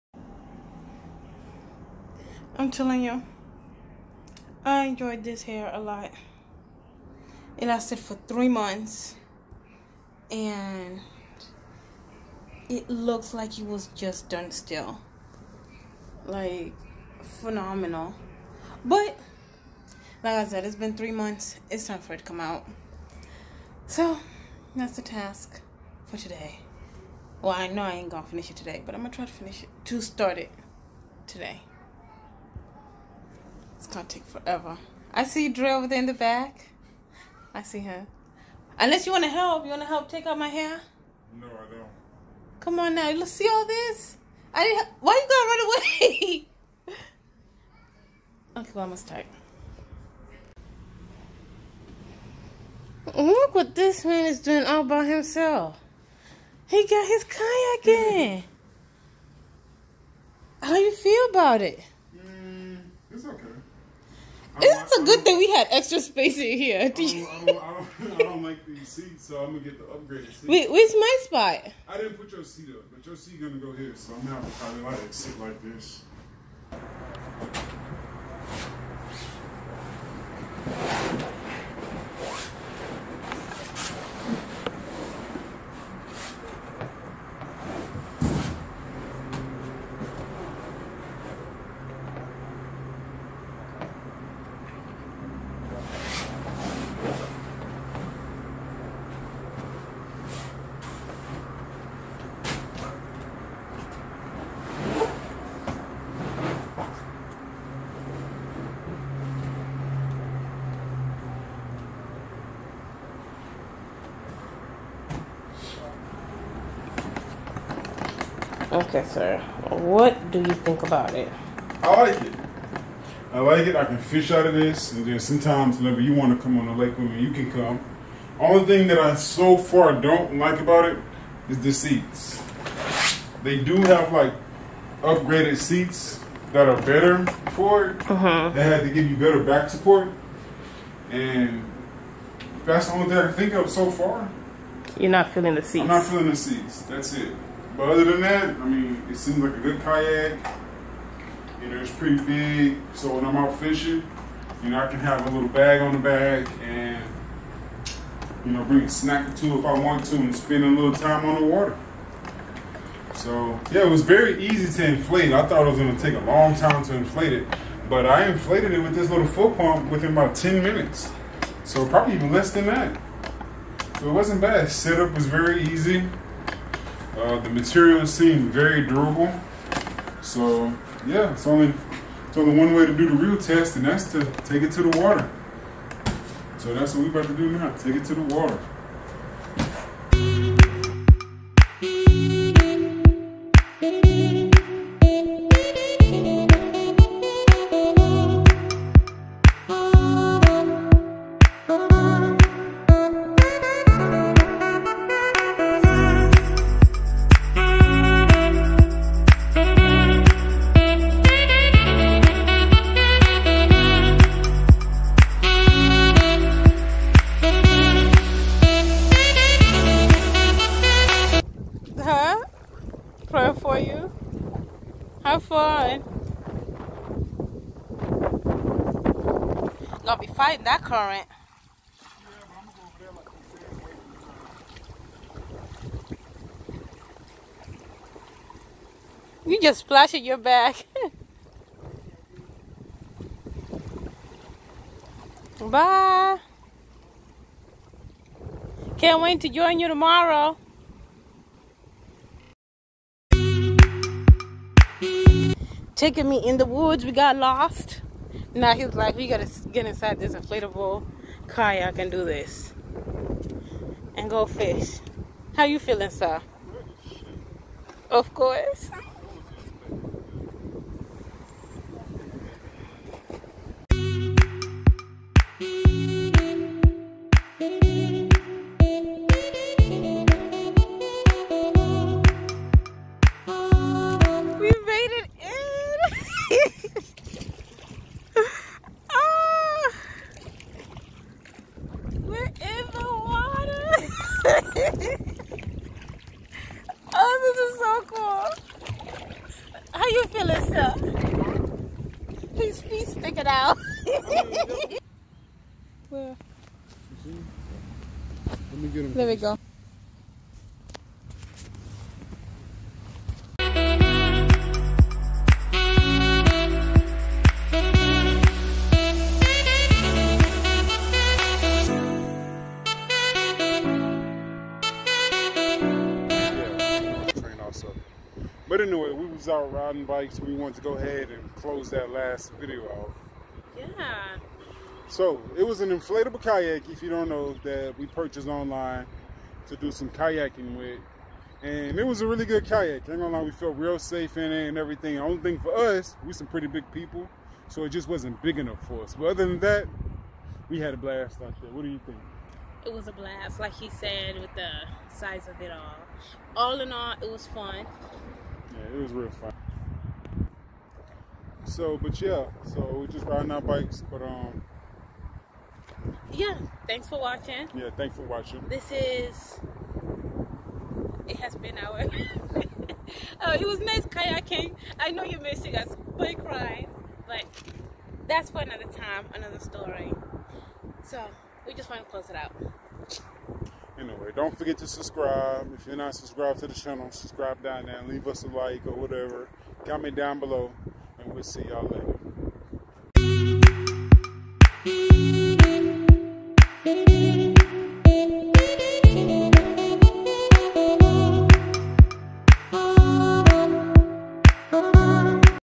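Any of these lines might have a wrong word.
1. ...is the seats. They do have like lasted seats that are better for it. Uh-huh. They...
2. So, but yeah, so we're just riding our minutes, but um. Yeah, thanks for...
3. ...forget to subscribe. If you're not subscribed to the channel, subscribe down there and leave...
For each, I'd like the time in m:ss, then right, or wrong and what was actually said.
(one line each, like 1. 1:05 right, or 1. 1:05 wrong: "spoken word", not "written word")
1. 2:11 wrong: "upgraded", not "lasted"
2. 6:01 wrong: "bikes", not "minutes"
3. 6:24 right.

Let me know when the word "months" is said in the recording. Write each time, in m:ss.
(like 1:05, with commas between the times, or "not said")
0:08, 0:21.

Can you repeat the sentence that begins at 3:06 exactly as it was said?
So that's what we're about to do now.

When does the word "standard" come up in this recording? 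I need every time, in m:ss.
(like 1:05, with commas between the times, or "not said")
not said.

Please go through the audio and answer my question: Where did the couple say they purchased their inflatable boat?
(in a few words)
Online.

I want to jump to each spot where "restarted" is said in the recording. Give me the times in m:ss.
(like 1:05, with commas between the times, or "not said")
not said.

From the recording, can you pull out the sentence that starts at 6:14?
I know you're missing us, boy crying, but that's for another time, another story.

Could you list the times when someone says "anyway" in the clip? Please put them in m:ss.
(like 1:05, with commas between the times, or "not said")
5:28, 6:23.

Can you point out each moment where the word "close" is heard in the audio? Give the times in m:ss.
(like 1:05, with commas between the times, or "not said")
5:31, 6:22.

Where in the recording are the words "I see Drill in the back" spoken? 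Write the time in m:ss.
0:35.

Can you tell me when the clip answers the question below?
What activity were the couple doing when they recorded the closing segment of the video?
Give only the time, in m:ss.
5:29.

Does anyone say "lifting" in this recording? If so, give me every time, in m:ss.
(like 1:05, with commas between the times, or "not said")
not said.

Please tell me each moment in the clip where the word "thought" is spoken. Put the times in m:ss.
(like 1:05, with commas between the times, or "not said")
2:45.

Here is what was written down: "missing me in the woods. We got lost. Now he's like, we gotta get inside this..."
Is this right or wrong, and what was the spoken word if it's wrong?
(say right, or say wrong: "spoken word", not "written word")
wrong: "taking", not "missing".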